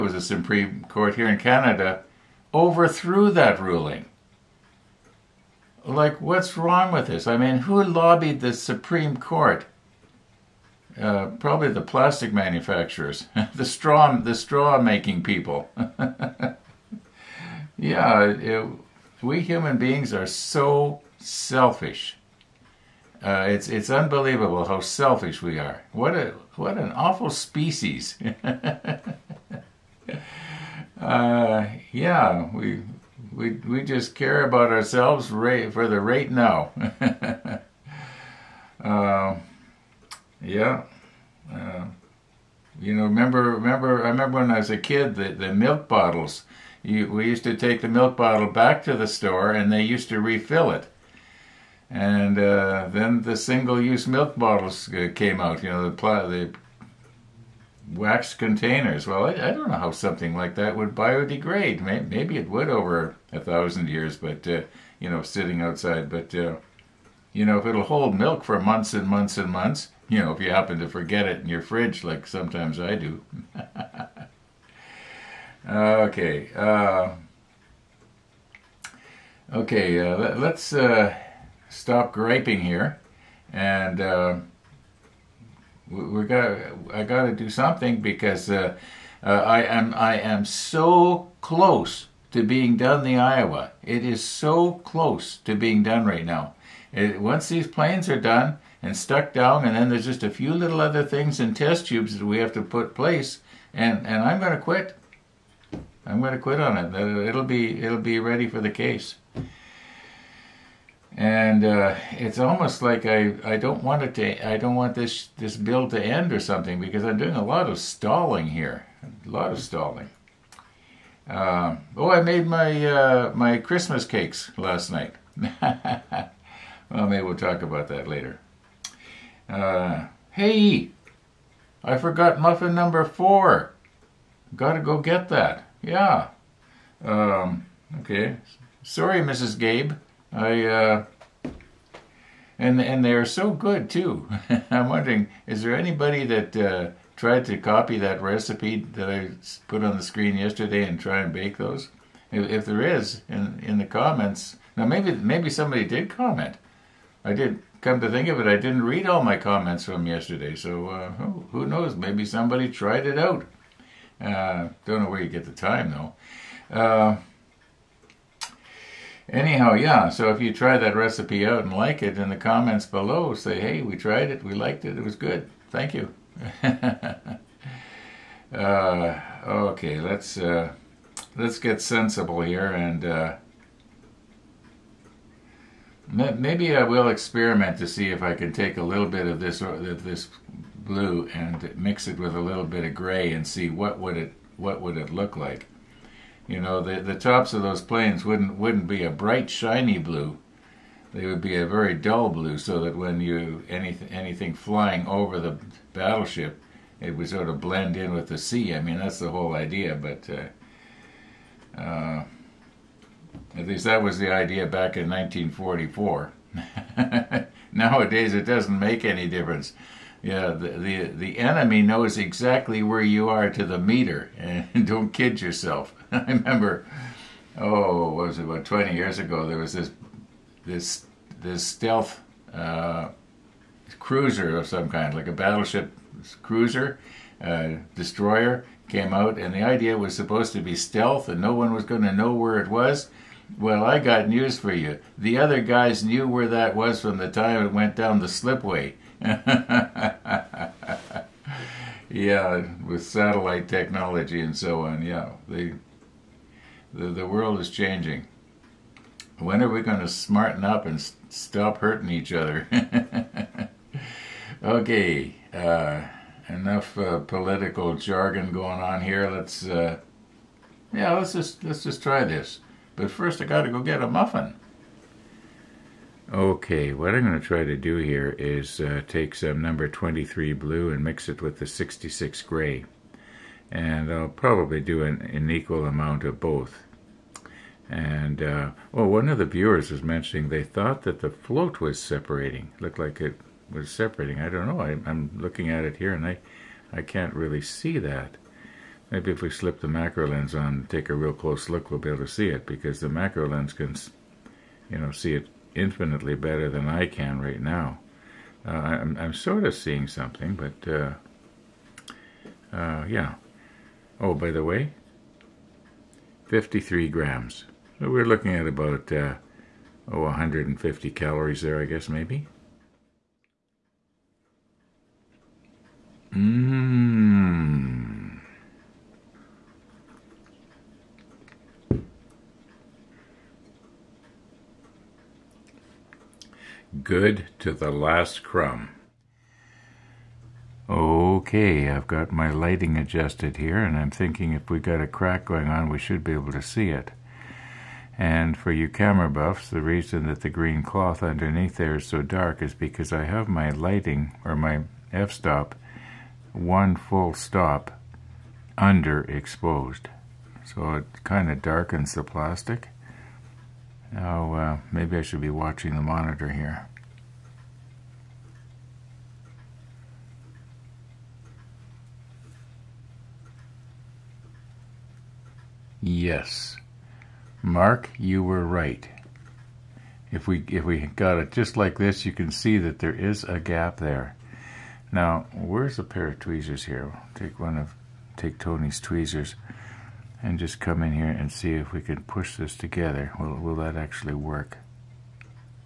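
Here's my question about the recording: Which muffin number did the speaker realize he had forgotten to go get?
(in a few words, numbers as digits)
4.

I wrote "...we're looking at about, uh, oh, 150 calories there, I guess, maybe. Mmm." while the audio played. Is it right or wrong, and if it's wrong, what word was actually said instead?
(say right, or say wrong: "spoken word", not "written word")
right.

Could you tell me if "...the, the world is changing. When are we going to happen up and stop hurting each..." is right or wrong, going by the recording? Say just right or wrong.
wrong.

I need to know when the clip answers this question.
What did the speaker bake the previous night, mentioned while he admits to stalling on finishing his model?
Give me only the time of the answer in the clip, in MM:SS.
02:03.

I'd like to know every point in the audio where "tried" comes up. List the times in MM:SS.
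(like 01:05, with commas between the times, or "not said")
02:27, 02:42, 02:53.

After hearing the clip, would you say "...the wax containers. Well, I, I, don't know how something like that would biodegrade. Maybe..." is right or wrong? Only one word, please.
right.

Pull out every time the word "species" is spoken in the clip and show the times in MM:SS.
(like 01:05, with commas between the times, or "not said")
00:27.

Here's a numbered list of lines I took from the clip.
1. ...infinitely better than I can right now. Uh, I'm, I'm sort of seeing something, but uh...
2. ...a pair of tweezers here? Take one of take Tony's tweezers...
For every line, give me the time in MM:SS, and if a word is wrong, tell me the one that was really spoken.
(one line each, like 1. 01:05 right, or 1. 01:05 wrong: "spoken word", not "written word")
1. 05:05 right
2. 06:25 right.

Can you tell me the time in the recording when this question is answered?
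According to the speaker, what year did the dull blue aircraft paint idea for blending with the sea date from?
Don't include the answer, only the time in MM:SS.
03:35.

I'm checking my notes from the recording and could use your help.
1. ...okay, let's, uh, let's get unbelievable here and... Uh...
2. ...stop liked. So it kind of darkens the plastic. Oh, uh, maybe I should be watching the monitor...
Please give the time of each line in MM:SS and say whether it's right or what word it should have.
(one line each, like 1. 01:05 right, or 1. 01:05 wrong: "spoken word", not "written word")
1. 02:59 wrong: "sensible", not "unbelievable"
2. 05:57 wrong: "underexposed", not "liked".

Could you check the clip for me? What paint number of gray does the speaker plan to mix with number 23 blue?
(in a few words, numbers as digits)
66.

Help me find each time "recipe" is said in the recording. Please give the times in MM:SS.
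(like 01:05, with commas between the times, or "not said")
02:28, 02:50.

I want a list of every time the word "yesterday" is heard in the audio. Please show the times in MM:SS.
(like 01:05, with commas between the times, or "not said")
02:30, 02:40.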